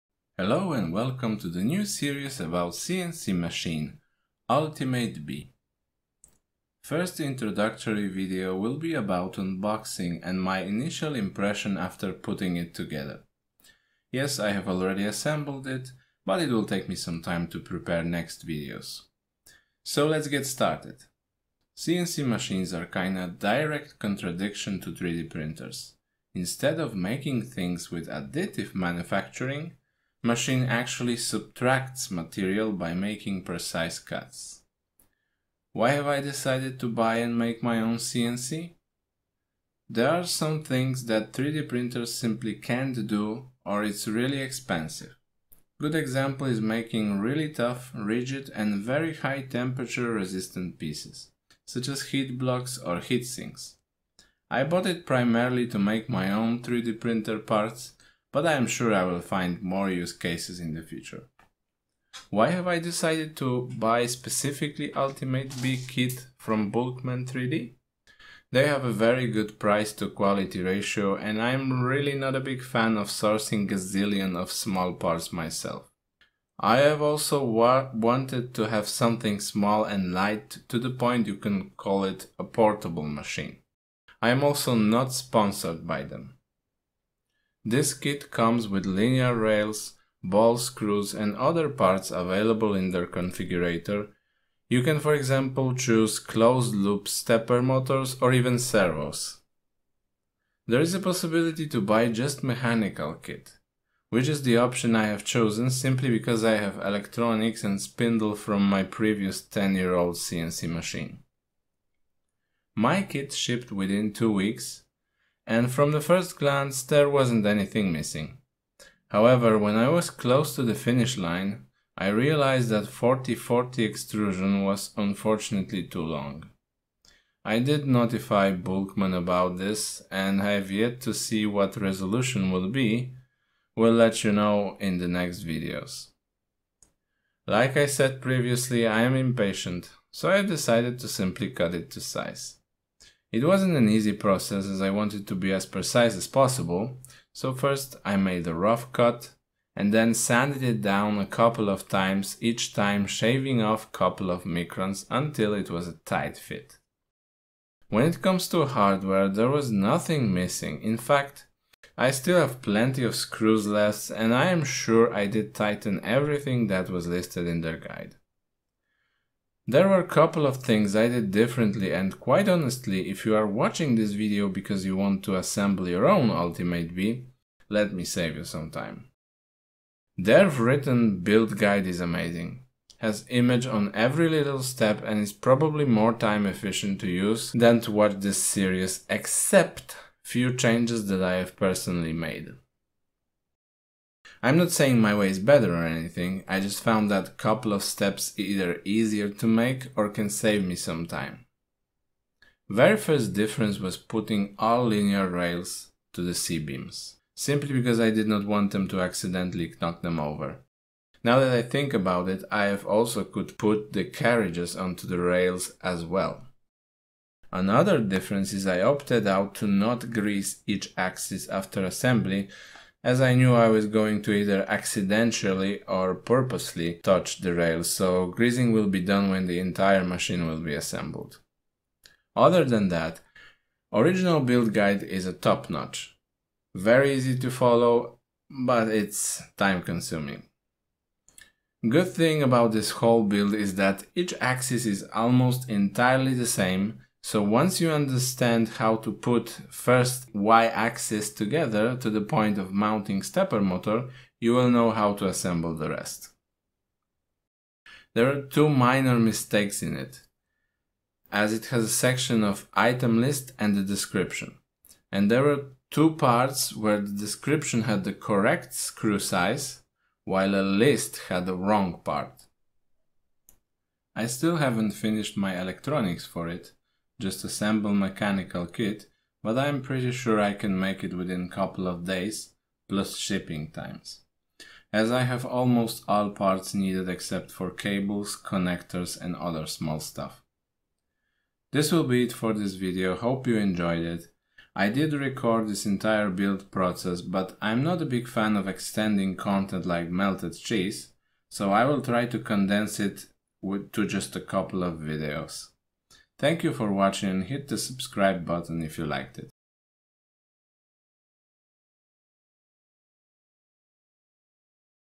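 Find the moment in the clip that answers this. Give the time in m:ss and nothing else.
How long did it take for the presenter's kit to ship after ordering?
1:54.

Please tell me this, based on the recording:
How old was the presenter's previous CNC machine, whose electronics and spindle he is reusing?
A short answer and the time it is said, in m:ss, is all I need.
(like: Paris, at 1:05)
10 years, at 1:49.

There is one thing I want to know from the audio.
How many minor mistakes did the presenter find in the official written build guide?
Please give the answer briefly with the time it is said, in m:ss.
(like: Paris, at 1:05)
2, at 4:18.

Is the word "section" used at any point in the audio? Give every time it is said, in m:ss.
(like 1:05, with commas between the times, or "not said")
4:21.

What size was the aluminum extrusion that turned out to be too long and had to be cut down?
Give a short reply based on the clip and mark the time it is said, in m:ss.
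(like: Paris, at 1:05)
40-40, at 2:02.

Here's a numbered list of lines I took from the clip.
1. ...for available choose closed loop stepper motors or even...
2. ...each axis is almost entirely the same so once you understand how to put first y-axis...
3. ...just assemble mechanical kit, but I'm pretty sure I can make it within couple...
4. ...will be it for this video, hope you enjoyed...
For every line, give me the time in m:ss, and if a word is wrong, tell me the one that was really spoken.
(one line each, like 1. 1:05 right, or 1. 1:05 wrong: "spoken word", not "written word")
1. 1:34 wrong: "example", not "available"
2. 4:04 right
3. 4:37 right
4. 4:51 right.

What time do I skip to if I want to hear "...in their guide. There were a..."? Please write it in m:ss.
2:47.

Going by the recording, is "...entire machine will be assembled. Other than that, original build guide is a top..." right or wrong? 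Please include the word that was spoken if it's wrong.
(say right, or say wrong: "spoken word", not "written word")
right.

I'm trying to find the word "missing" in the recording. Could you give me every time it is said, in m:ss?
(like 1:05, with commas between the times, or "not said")
1:57, 2:40.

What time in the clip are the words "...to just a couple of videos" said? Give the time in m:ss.
5:03.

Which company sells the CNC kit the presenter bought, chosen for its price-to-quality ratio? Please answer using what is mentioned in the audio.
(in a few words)
Bulkman 3D.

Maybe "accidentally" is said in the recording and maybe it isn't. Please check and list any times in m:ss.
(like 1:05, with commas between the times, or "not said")
3:29, 3:44.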